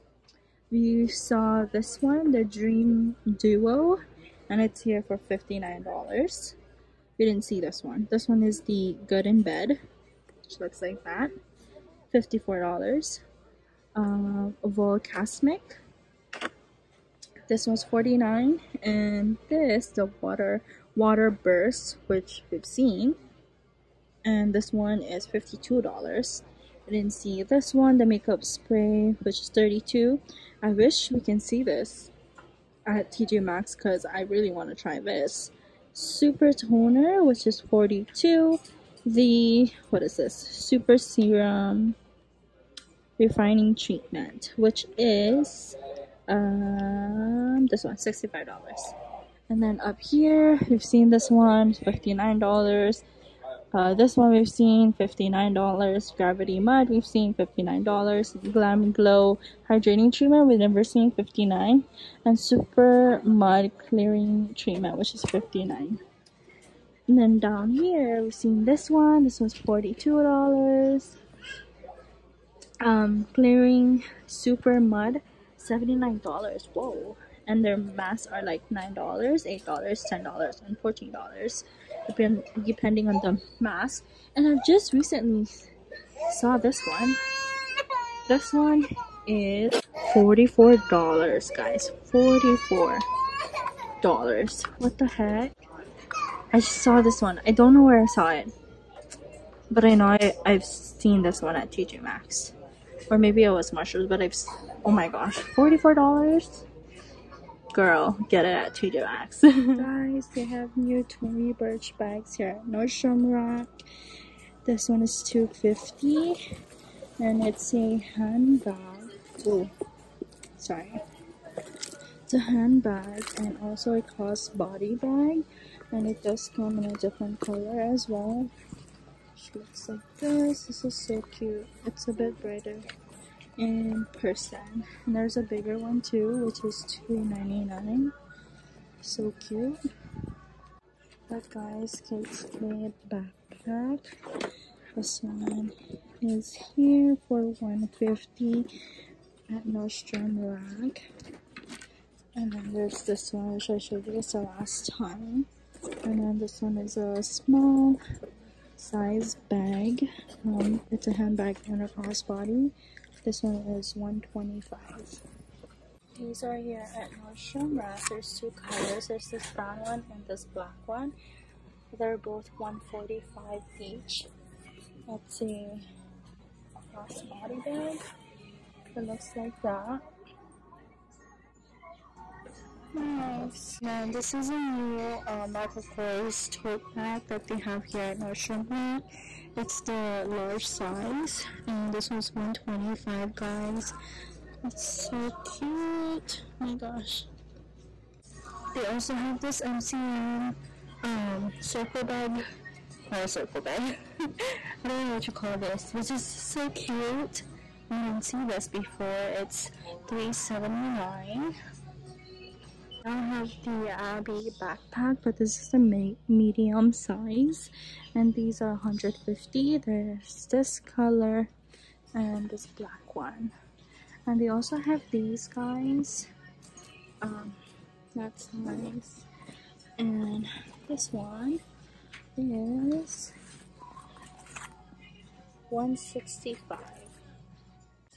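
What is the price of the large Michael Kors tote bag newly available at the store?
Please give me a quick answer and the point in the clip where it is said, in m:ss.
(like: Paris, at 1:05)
$125, at 3:11.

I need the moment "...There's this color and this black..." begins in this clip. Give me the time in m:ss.
3:39.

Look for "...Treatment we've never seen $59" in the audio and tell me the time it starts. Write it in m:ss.
1:00.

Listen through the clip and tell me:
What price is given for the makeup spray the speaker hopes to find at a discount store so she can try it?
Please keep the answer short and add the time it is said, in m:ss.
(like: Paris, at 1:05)
$32, at 0:29.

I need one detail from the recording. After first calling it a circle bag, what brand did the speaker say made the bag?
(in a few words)
MCM.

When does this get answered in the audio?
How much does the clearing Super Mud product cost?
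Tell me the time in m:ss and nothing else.
1:15.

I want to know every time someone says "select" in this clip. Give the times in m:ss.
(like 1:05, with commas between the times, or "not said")
not said.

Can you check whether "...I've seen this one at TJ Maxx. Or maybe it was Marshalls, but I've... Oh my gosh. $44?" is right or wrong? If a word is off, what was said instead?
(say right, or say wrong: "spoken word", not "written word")
right.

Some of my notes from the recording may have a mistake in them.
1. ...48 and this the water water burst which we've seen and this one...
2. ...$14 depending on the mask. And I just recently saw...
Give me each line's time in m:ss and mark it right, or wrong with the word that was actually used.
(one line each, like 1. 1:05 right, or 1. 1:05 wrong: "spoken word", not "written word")
1. 0:17 wrong: "49", not "48"
2. 1:20 right.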